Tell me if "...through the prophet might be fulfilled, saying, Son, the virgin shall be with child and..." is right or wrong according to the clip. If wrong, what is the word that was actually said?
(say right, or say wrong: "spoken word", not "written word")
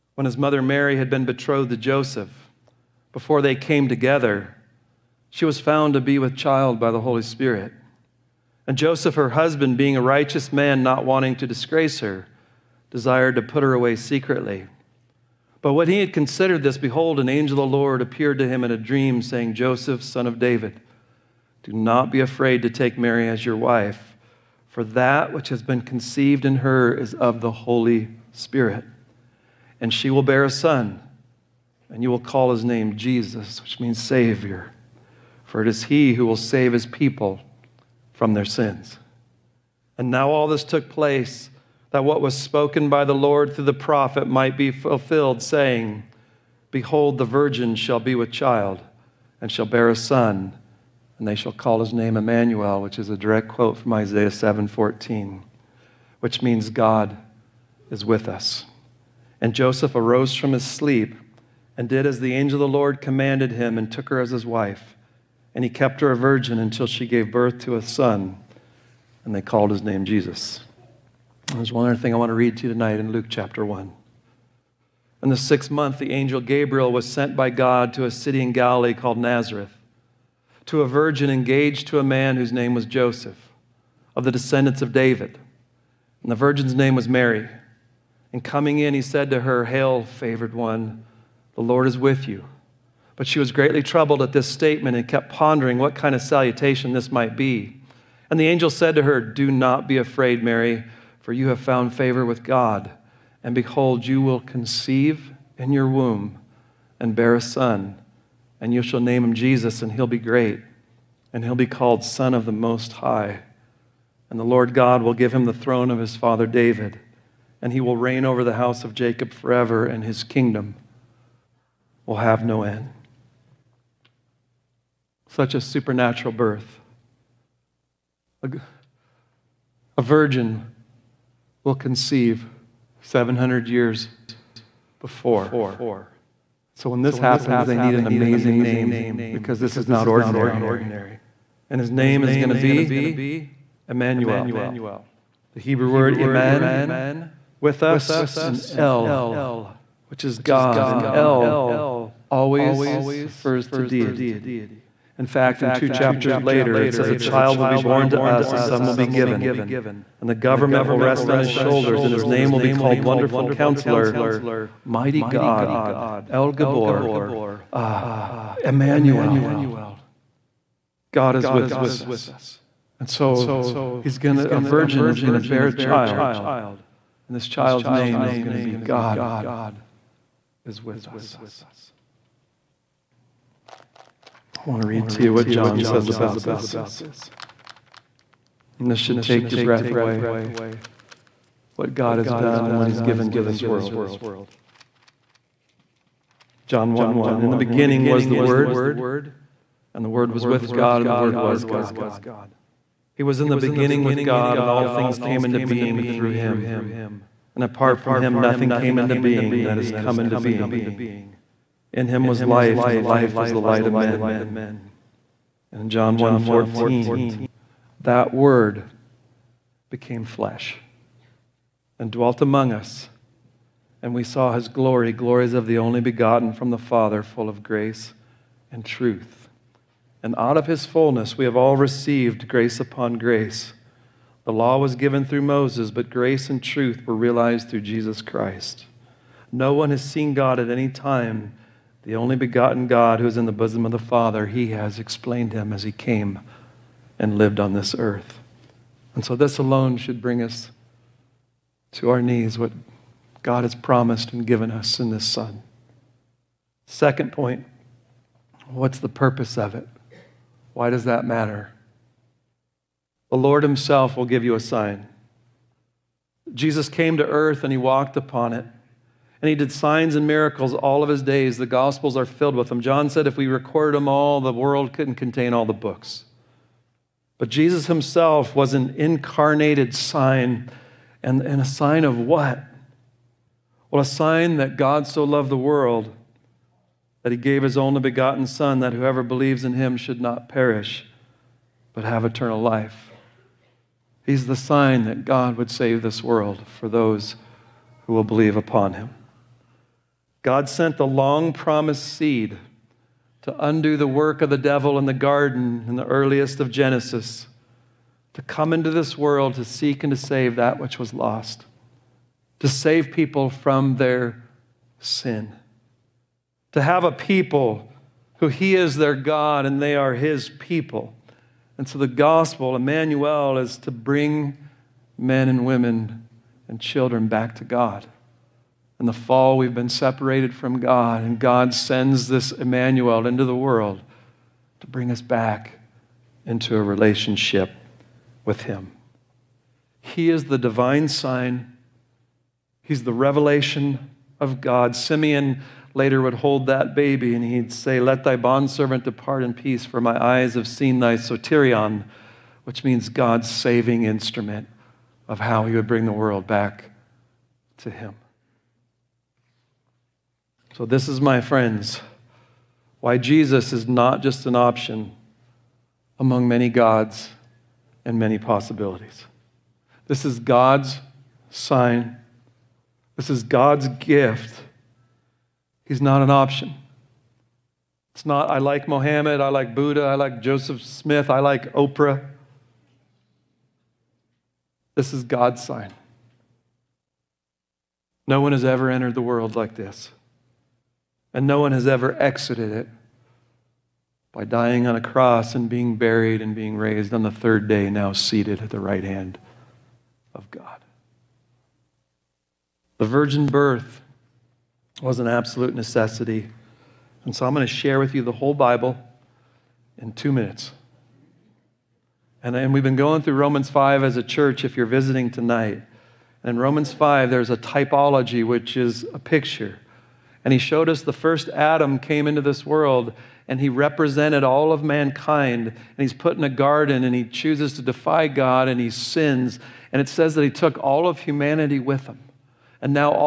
wrong: "Behold", not "Son".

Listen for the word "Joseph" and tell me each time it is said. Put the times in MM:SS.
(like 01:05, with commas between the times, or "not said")
00:01, 00:08, 00:19, 00:59, 01:22, 06:20.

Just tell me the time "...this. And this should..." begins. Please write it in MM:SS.
03:06.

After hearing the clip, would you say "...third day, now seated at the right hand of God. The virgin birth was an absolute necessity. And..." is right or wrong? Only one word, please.
right.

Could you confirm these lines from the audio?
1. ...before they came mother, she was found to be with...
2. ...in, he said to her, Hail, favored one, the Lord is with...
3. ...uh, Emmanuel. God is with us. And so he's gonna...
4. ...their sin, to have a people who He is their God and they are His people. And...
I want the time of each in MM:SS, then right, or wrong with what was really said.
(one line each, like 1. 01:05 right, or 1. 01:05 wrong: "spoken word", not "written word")
1. 00:03 wrong: "together", not "mother"
2. 01:28 right
3. 02:47 right
4. 05:13 right.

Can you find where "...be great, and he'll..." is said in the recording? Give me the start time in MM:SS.
01:50.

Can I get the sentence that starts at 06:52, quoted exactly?
And, and we've been going through Romans 5 as a church if you're visiting tonight.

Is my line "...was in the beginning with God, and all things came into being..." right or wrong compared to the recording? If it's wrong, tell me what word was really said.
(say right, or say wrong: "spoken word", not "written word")
right.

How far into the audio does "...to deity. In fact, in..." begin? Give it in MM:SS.
02:33.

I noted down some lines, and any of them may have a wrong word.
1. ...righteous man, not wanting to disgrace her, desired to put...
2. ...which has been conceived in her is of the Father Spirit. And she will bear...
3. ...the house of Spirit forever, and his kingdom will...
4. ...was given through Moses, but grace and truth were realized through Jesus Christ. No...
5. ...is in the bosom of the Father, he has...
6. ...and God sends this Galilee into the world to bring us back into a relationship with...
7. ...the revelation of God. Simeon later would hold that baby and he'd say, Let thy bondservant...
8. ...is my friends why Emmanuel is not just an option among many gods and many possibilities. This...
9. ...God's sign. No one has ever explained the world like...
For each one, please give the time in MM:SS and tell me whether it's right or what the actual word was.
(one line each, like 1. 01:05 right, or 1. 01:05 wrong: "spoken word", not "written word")
1. 00:10 right
2. 00:25 wrong: "Holy", not "Father"
3. 01:58 wrong: "Jacob", not "Spirit"
4. 03:54 right
5. 04:03 right
6. 05:31 wrong: "Emmanuel", not "Galilee"
7. 05:43 right
8. 06:01 wrong: "Jesus", not "Emmanuel"
9. 06:25 wrong: "entered", not "explained".